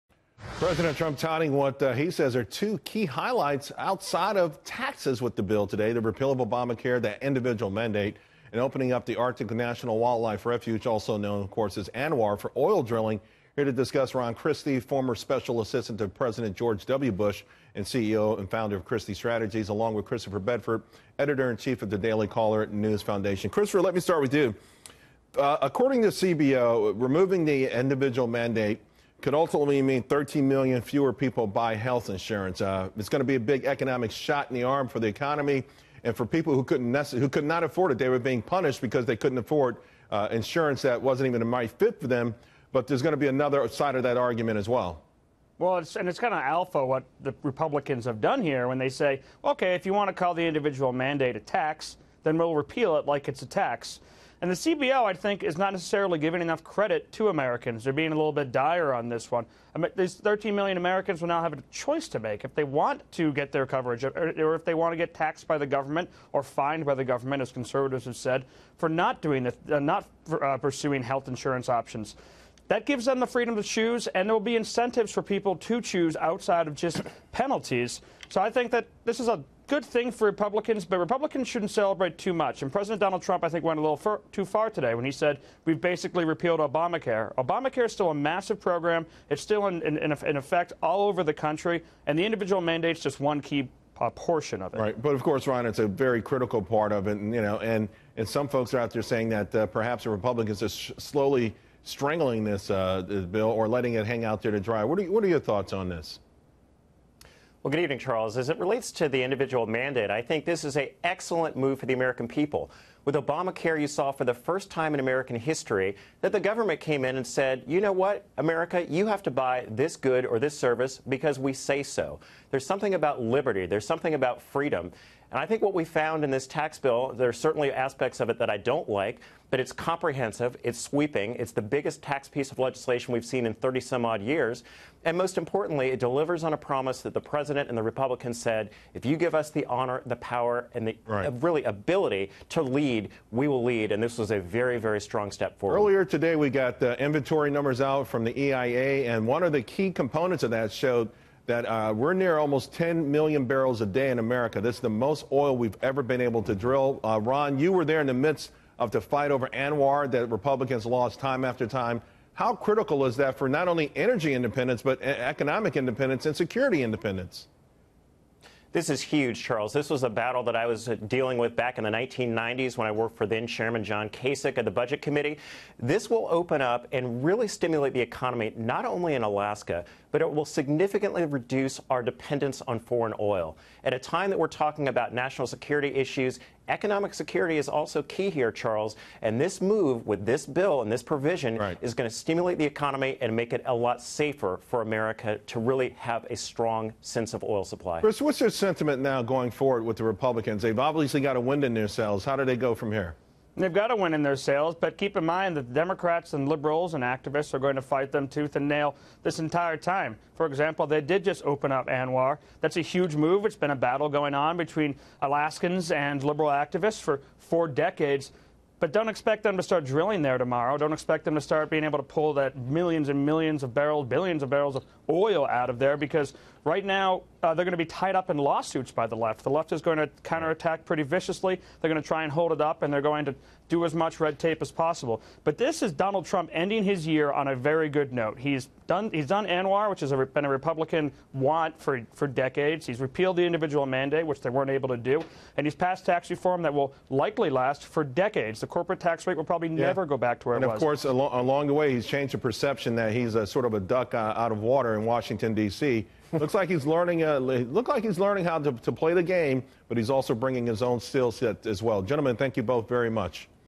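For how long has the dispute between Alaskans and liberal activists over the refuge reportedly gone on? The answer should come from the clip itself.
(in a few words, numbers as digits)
four decades.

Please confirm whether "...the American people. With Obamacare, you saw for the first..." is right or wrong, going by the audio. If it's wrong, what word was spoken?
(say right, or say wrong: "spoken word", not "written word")
right.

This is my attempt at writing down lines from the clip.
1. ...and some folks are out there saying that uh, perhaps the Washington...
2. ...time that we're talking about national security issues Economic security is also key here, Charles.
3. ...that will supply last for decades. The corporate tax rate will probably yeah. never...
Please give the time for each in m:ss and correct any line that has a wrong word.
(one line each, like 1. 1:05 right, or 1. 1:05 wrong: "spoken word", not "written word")
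1. 1:38 wrong: "Republicans", not "Washington"
2. 3:03 right
3. 4:06 wrong: "likely", not "supply".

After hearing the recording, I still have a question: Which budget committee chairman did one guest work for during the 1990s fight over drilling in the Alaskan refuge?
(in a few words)
John Kasich.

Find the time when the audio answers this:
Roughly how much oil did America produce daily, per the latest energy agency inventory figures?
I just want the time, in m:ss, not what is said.
2:32.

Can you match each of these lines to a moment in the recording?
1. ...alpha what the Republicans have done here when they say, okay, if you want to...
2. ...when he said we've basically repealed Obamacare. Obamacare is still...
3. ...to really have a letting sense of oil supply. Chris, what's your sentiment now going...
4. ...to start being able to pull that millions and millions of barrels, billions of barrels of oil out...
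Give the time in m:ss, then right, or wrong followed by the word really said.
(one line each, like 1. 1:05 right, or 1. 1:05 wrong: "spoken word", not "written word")
1. 0:46 right
2. 1:24 right
3. 3:15 wrong: "strong", not "letting"
4. 3:41 right.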